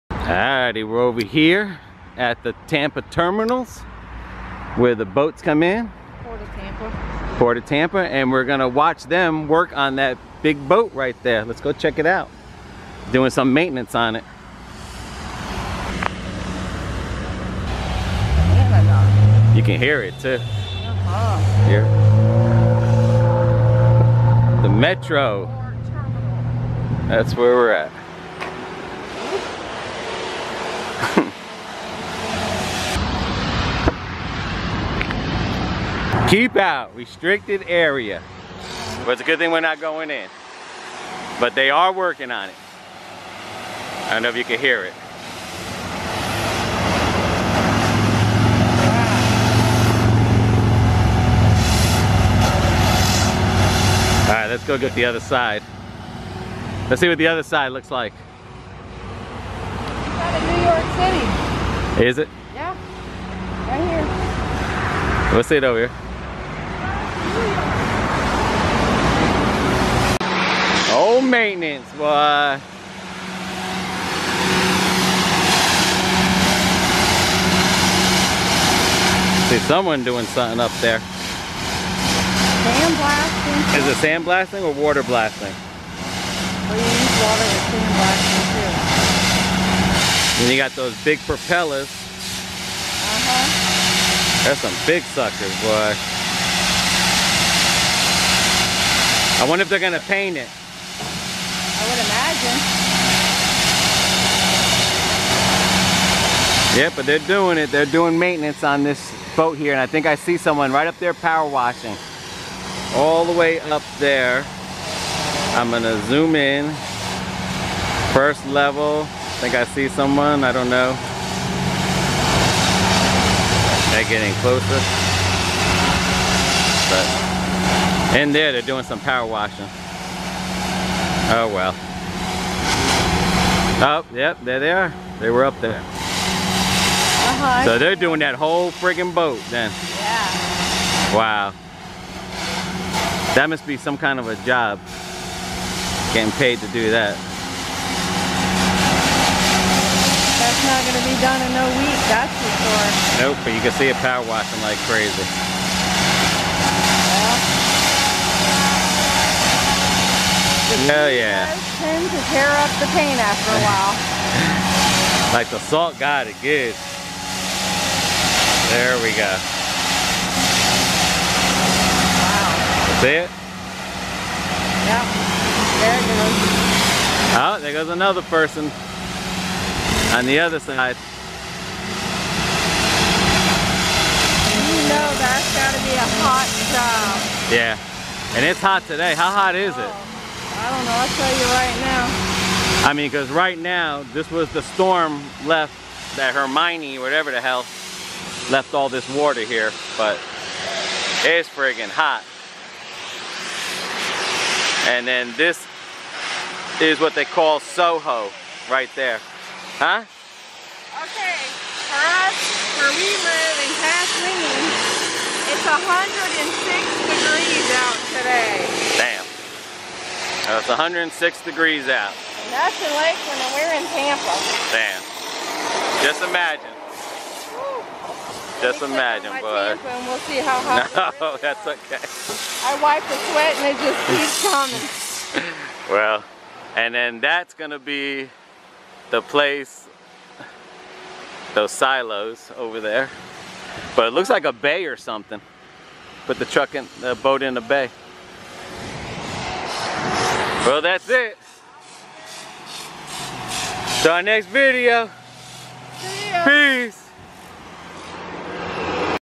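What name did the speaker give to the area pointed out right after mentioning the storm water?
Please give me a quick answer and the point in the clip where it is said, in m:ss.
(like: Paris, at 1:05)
Soho, at 3:27.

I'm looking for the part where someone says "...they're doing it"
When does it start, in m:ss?
1:47.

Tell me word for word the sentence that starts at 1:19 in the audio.
See someone doing something up there.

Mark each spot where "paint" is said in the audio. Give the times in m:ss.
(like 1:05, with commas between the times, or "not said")
1:39, 2:42.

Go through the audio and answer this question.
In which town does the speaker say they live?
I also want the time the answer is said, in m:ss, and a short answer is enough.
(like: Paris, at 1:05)
Kathleen, at 3:33.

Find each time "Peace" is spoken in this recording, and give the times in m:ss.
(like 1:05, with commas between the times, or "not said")
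4:16.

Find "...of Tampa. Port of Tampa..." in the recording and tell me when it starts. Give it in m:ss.
0:06.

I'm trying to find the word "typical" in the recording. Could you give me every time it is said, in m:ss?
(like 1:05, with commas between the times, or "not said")
not said.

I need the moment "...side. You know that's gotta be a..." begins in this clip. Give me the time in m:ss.
3:00.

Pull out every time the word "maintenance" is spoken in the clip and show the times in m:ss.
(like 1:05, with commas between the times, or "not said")
0:13, 1:11, 1:48.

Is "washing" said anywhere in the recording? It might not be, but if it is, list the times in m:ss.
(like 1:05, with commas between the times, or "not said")
1:51, 2:09, 2:34.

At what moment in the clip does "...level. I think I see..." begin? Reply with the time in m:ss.
1:58.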